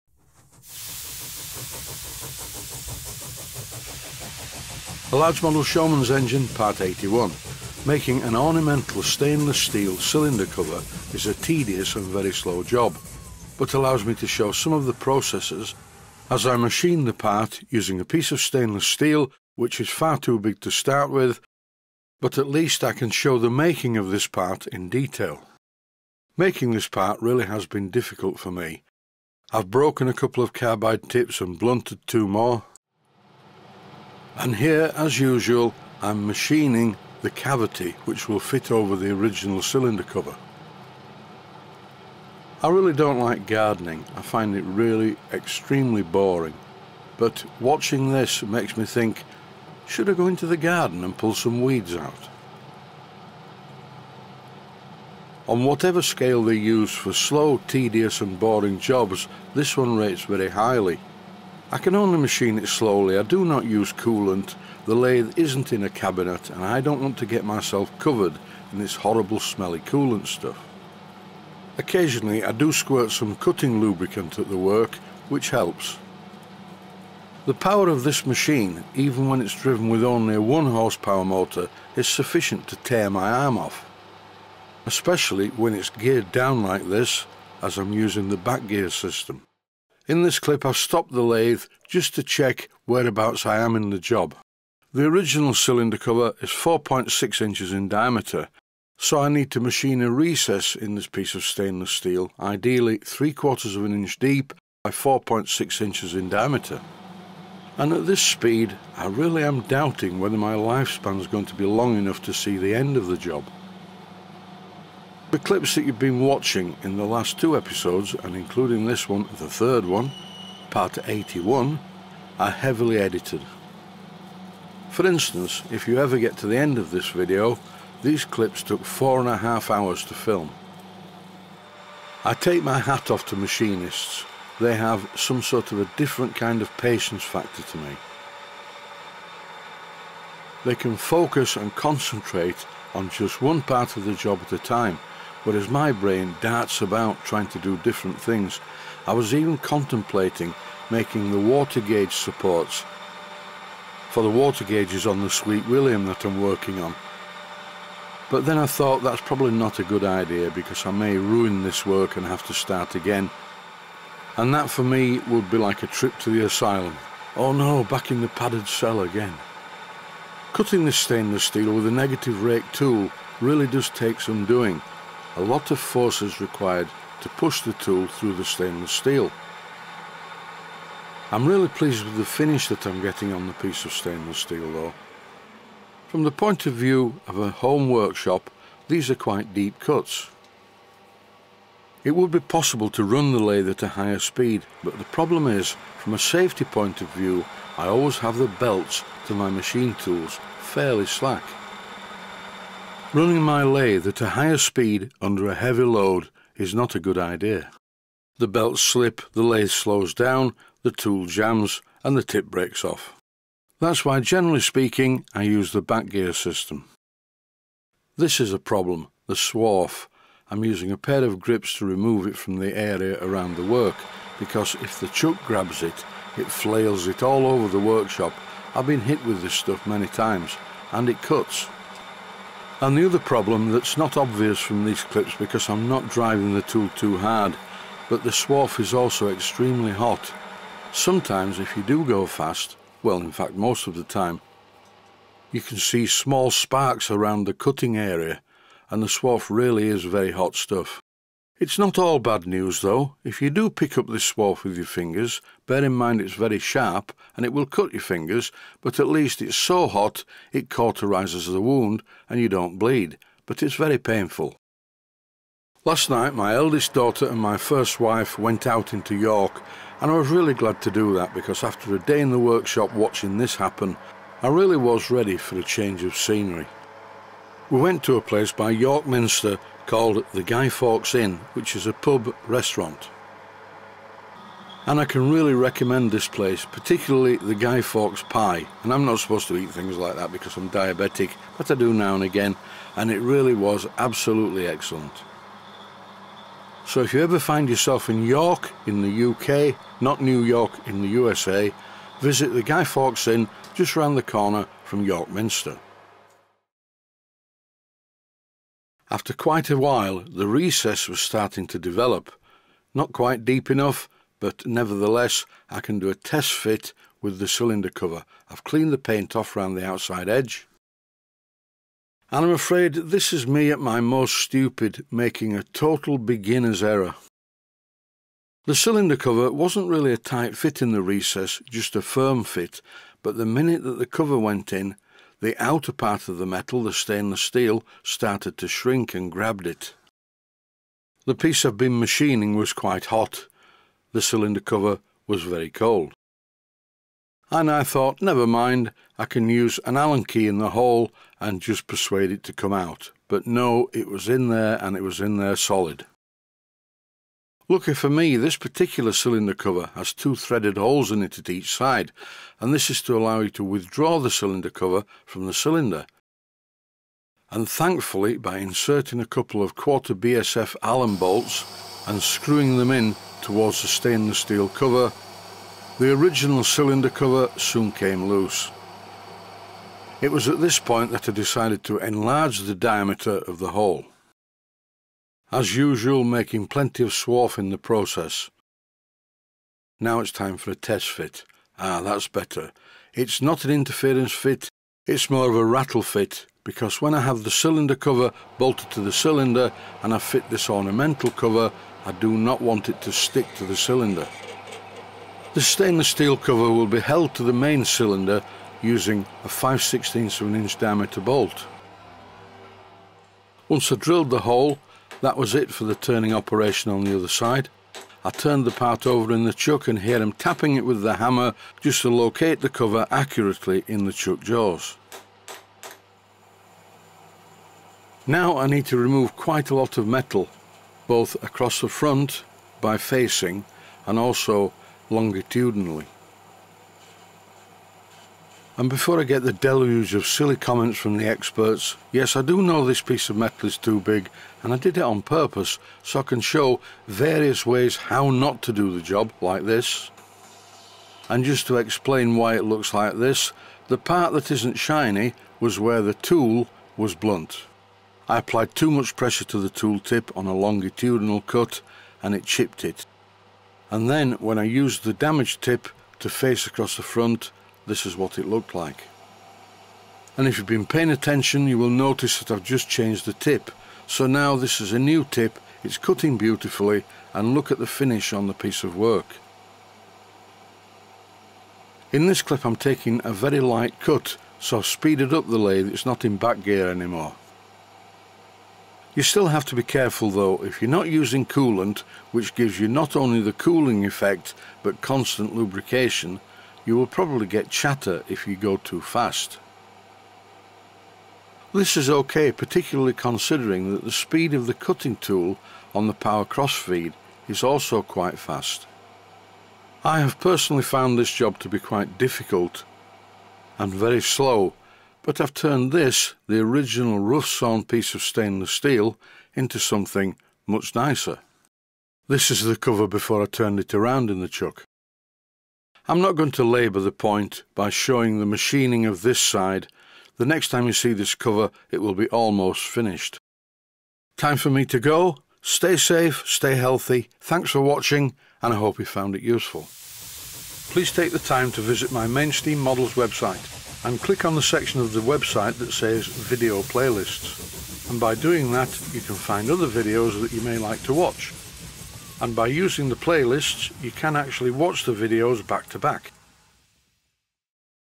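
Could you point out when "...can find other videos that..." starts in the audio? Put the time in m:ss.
9:09.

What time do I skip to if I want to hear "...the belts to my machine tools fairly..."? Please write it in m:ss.
3:18.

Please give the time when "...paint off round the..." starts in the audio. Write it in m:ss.
5:18.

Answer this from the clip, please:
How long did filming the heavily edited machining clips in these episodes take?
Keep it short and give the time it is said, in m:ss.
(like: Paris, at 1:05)
four and a half hours, at 2:08.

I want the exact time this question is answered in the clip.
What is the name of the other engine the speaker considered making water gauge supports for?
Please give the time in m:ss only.
2:35.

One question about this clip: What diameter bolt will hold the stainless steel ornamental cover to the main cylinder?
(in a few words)
5/16 inch.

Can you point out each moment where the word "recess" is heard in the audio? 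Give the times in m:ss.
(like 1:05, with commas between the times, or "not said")
1:40, 5:10, 5:31.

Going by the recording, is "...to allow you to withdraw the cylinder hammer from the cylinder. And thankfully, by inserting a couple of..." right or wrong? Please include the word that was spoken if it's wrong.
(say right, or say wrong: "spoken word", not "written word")
wrong: "cover", not "hammer".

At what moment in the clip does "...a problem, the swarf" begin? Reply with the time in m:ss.
3:38.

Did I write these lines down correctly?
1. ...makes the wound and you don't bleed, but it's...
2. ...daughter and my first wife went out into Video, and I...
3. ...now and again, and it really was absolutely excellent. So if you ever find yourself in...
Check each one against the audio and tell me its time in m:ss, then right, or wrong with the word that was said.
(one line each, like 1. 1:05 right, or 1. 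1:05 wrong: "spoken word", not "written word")
1. 4:20 wrong: "cauterises", not "makes"
2. 4:26 wrong: "York", not "Video"
3. 4:51 right.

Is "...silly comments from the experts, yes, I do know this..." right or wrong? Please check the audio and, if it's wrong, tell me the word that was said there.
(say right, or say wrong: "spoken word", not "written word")
right.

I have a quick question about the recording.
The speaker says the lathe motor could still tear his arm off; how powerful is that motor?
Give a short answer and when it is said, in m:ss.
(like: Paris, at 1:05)
1 horsepower, at 1:20.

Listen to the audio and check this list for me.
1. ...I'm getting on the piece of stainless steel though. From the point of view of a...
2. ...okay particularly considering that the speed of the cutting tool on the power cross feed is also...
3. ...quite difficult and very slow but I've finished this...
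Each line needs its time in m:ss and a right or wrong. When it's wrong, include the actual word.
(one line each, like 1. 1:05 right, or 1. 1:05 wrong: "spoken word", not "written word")
1. 3:02 right
2. 8:22 right
3. 8:31 wrong: "turned", not "finished".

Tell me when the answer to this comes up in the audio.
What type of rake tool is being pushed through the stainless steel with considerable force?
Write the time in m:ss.
2:51.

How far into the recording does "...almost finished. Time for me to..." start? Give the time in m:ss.
8:52.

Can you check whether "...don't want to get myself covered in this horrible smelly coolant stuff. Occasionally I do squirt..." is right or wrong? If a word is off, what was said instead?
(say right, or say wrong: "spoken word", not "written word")
right.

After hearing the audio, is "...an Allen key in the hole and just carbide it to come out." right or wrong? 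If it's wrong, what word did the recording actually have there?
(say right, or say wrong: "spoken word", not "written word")
wrong: "persuade", not "carbide".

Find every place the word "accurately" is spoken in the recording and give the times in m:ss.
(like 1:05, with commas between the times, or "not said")
7:03.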